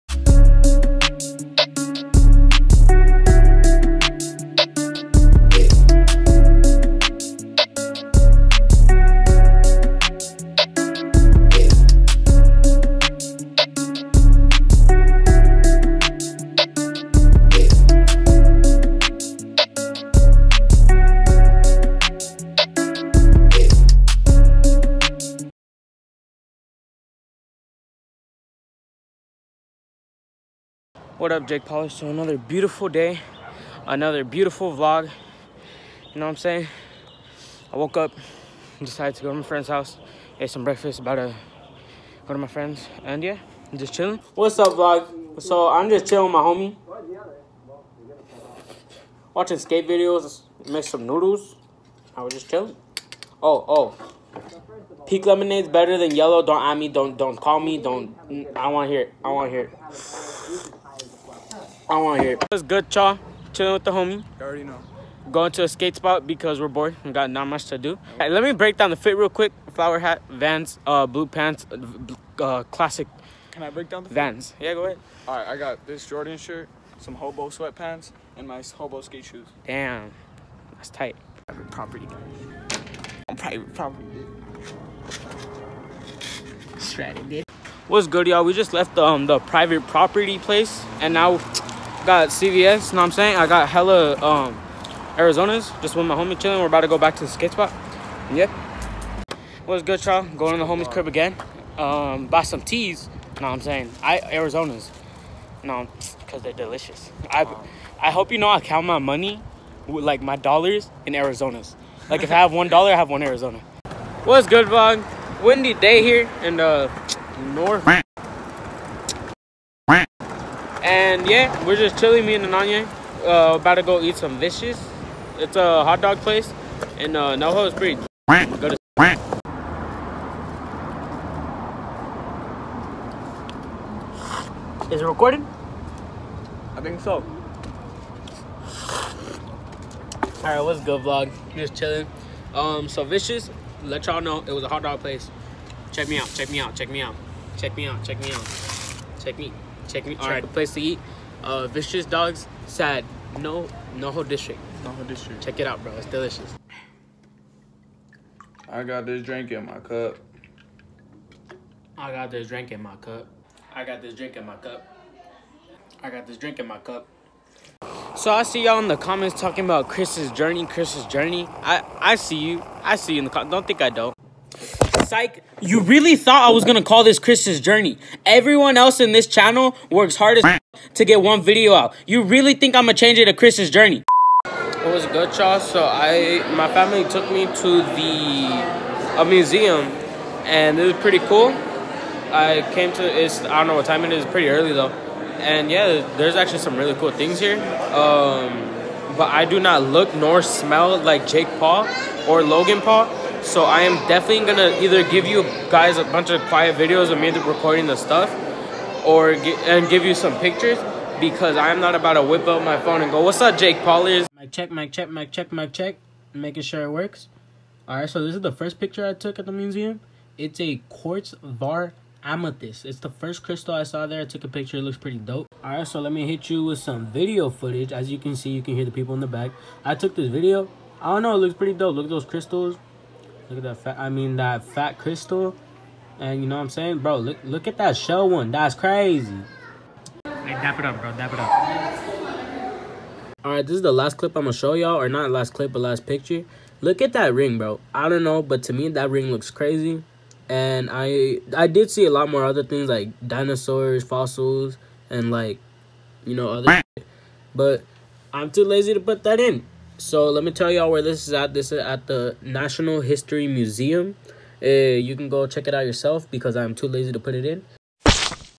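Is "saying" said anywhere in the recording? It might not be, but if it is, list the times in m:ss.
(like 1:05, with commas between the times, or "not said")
0:36, 1:33, 1:43, 3:56.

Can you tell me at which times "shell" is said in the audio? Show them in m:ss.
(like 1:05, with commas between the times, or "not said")
3:57.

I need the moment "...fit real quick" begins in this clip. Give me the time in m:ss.
1:08.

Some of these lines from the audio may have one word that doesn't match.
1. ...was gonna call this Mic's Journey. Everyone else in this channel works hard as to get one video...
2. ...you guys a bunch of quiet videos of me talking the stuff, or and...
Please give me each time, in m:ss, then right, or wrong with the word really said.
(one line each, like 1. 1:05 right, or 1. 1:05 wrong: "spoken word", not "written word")
1. 2:56 wrong: "Chris", not "Mic"
2. 3:25 wrong: "recording", not "talking".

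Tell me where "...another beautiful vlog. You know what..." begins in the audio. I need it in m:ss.
0:33.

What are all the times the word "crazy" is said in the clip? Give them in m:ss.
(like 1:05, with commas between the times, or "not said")
3:58, 4:09.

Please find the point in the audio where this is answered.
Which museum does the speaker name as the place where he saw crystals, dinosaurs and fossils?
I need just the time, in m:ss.
4:22.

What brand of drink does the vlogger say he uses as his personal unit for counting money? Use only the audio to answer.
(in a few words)
Arizona.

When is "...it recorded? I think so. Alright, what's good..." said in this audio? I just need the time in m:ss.
2:15.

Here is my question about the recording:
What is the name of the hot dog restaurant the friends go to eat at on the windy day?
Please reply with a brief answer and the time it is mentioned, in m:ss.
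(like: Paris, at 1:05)
Vicious Dogs, at 2:31.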